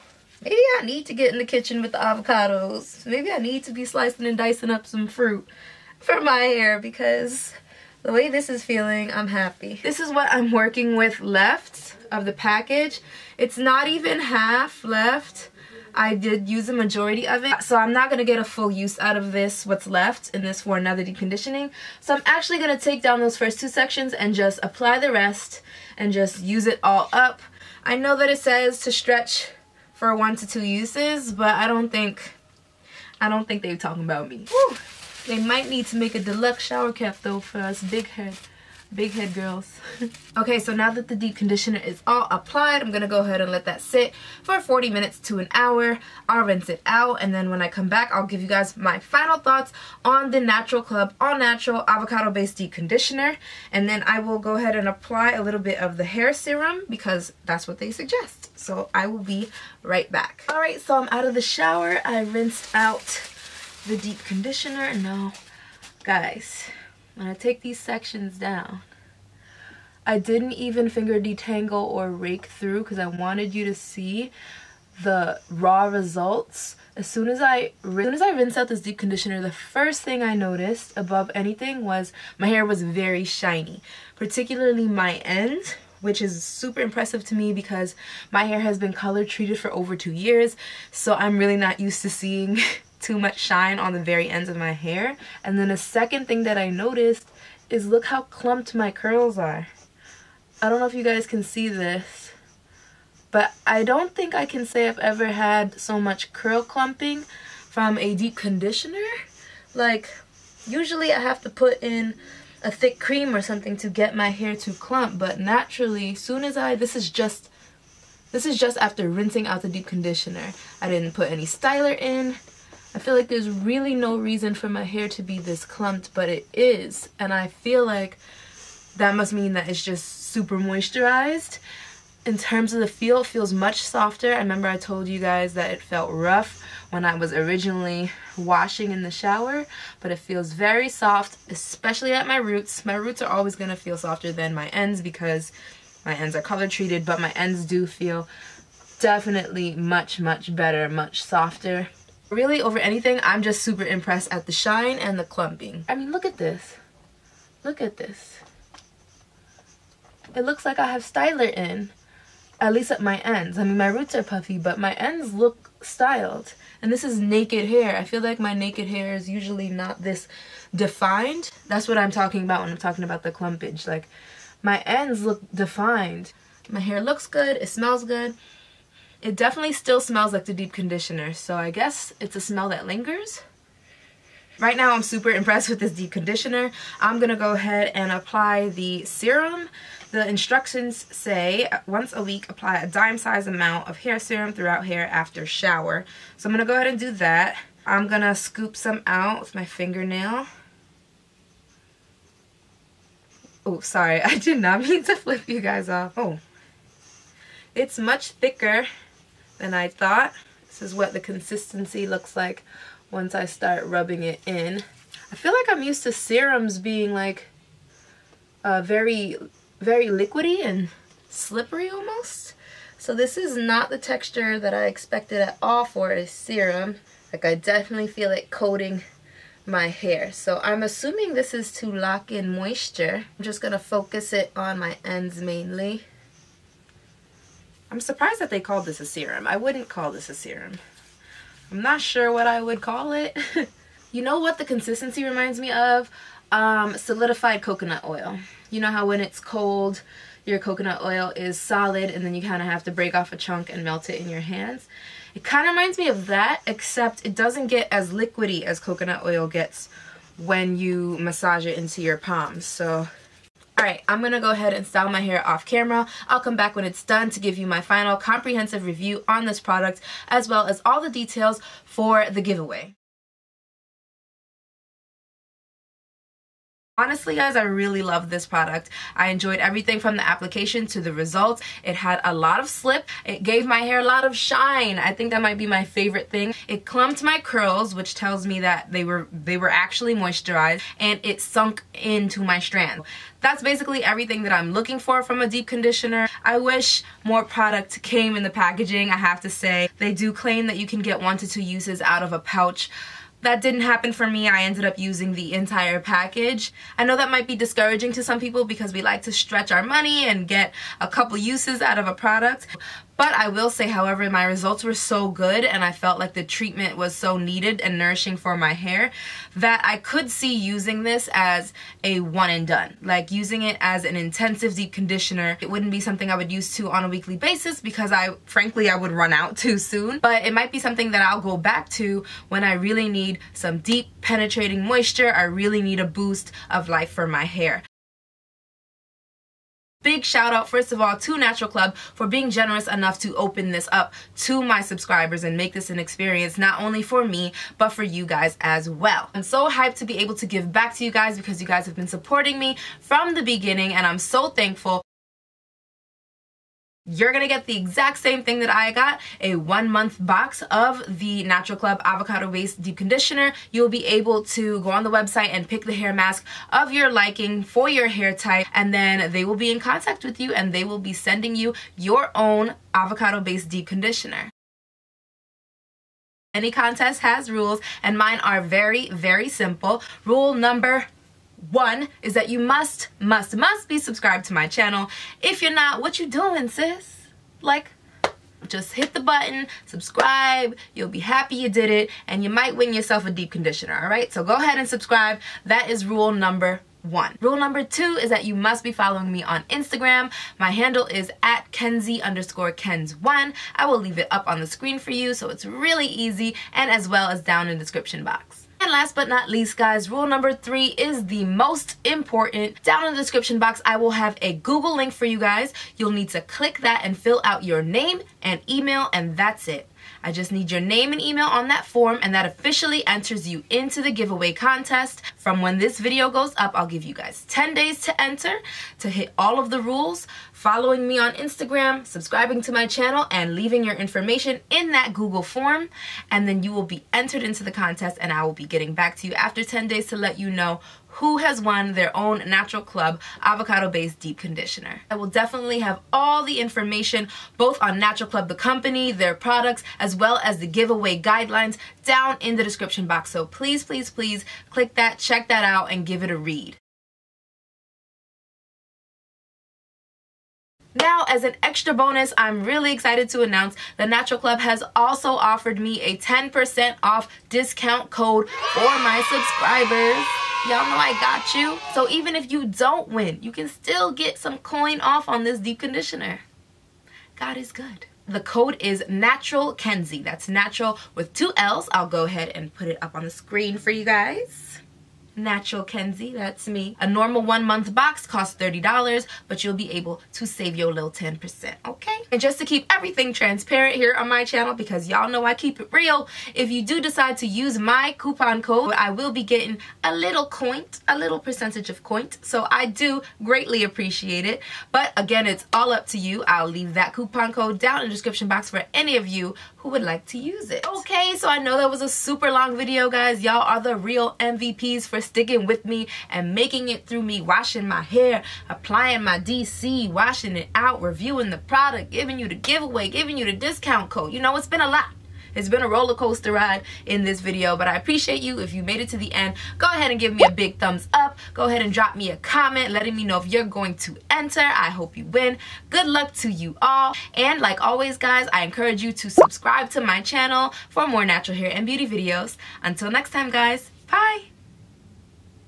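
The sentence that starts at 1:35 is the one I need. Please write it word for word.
And then the second thing that I noticed is look how clumped my curls are.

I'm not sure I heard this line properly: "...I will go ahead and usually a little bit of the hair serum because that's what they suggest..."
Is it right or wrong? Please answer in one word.
wrong.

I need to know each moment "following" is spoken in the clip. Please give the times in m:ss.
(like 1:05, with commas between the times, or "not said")
6:38, 7:10.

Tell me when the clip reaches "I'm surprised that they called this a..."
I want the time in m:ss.
3:57.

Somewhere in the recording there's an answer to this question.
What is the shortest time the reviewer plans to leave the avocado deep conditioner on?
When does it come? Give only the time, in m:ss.
0:44.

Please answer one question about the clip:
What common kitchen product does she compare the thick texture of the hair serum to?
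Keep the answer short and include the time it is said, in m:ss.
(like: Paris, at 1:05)
solidified coconut oil, at 4:06.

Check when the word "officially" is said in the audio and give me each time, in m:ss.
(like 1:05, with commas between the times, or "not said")
7:02.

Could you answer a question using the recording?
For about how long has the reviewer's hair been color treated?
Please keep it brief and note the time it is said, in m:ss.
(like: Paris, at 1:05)
2 years, at 1:29.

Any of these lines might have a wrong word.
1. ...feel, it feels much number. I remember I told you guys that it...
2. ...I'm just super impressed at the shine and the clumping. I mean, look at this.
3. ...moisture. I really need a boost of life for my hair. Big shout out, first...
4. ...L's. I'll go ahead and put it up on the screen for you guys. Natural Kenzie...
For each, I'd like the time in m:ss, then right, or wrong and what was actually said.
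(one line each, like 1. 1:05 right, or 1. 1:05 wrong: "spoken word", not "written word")
1. 2:12 wrong: "softer", not "number"
2. 2:33 right
3. 5:34 right
4. 8:01 right.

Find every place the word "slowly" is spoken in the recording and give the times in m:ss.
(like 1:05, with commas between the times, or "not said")
not said.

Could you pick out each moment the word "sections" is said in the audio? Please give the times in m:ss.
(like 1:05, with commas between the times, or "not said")
0:23, 1:07.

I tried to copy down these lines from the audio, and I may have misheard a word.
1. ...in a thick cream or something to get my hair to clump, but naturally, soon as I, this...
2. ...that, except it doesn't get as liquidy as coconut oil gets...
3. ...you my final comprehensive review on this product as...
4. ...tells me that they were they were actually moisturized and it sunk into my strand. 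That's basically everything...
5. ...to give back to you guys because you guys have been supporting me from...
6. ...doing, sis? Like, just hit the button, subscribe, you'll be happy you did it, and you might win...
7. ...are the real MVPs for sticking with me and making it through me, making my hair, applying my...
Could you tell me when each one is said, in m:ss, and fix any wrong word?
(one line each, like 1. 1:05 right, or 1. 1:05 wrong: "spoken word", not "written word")
1. 1:51 right
2. 4:16 right
3. 4:27 right
4. 4:48 right
5. 5:50 right
6. 6:26 right
7. 8:33 wrong: "washing", not "making".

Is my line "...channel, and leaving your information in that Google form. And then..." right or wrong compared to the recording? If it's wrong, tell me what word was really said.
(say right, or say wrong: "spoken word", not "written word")
right.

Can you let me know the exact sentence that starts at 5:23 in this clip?
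Like using it as an intensive deep conditioner.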